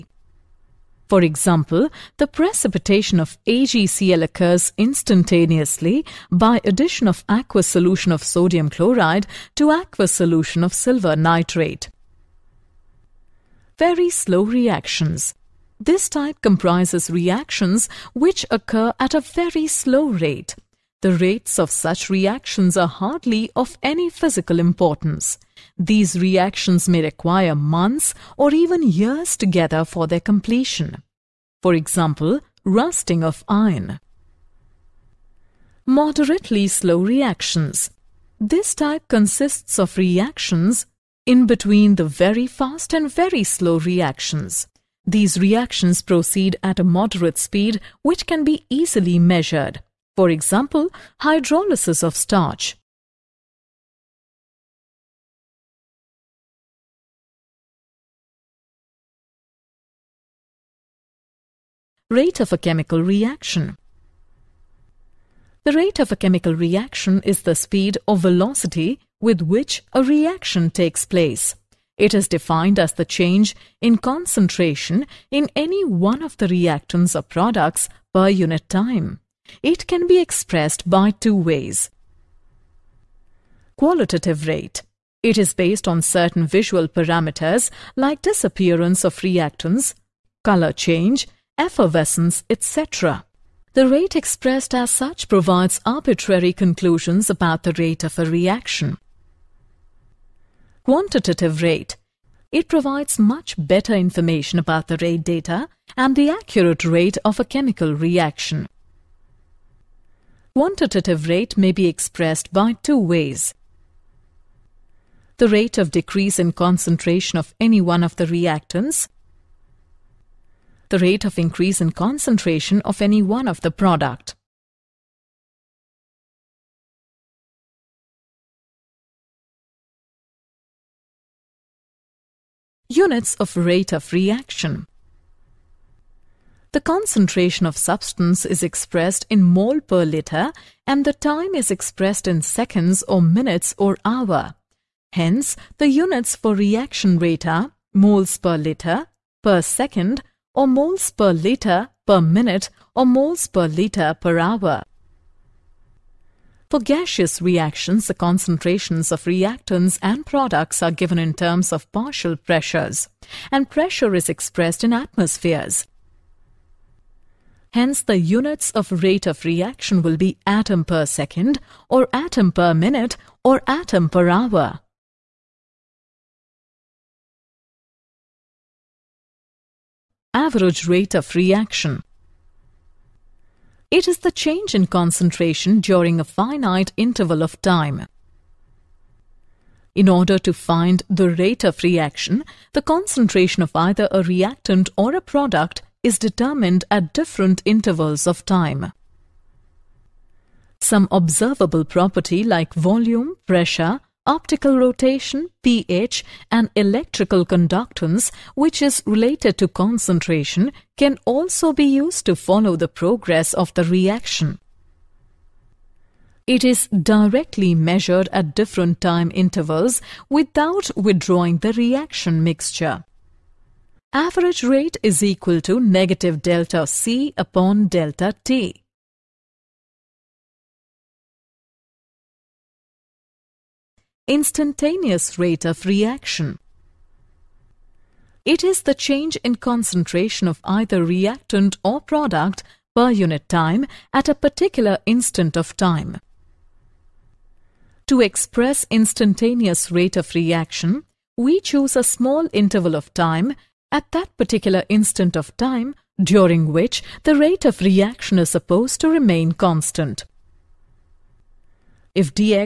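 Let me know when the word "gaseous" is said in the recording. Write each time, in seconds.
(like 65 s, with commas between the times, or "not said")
156 s.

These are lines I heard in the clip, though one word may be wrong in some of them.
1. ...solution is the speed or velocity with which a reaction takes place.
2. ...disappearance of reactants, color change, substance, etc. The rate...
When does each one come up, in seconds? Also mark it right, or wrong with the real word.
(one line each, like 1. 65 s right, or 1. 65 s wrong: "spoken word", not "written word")
1. 66 s wrong: "reaction", not "solution"
2. 88 s wrong: "effervescence", not "substance".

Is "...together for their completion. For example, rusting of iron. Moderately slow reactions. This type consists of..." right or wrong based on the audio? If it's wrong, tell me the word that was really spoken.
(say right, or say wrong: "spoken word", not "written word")
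right.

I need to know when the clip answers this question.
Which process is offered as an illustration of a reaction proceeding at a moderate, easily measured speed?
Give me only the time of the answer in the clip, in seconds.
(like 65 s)
51 s.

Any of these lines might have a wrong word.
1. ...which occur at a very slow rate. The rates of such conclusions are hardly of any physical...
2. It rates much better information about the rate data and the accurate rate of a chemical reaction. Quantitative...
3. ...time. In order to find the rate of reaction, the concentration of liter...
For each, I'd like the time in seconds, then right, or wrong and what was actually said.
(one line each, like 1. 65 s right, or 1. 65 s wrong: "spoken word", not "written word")
1. 18 s wrong: "reactions", not "conclusions"
2. 102 s wrong: "provides", not "rates"
3. 187 s wrong: "either", not "liter".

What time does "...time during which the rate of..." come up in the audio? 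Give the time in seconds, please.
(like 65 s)
255 s.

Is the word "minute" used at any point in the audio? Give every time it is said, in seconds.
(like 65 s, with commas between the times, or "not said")
143 s, 152 s, 172 s.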